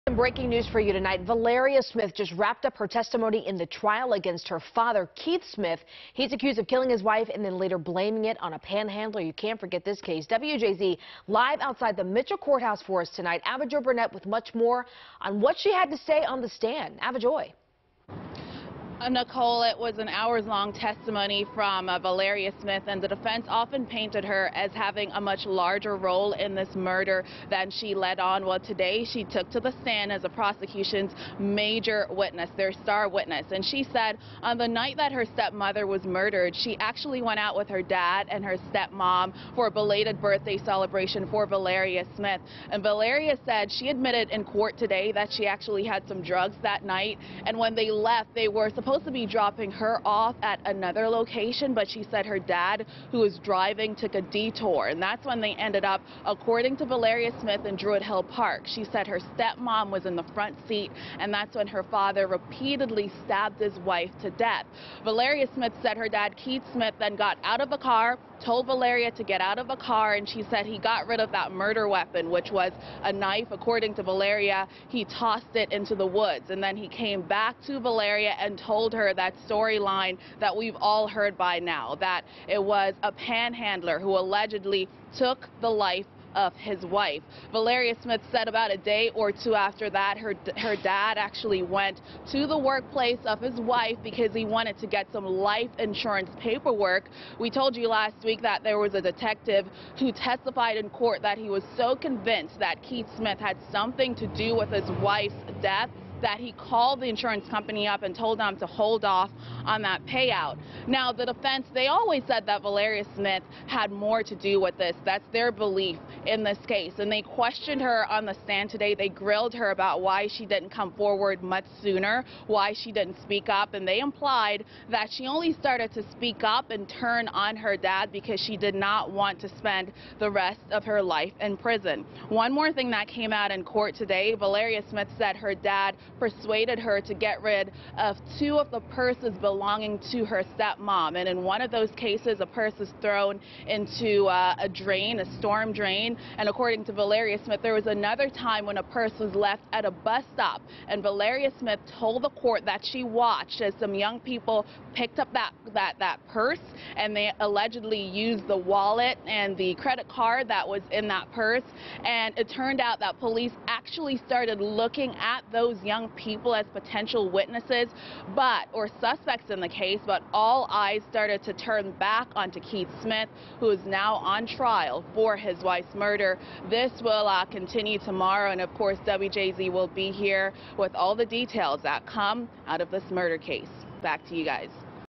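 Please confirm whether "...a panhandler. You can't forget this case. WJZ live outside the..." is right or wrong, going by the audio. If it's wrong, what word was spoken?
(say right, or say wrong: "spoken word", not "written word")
right.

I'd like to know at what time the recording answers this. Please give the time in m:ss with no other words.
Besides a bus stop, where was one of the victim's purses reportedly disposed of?
2:25.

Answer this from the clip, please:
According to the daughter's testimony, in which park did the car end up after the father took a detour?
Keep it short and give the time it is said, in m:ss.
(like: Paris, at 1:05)
Druid Hill Park, at 0:57.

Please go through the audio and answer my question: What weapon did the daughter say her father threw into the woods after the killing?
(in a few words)
A knife.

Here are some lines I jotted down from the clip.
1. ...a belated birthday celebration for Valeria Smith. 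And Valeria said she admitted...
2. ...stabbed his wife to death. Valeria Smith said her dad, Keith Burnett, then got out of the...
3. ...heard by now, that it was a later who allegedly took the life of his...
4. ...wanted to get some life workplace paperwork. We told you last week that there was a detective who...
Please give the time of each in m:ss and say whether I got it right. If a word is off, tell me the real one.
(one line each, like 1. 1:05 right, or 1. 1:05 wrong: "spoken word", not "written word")
1. 0:39 right
2. 1:03 wrong: "Smith", not "Burnett"
3. 1:21 wrong: "panhandler", not "later"
4. 1:34 wrong: "insurance", not "workplace".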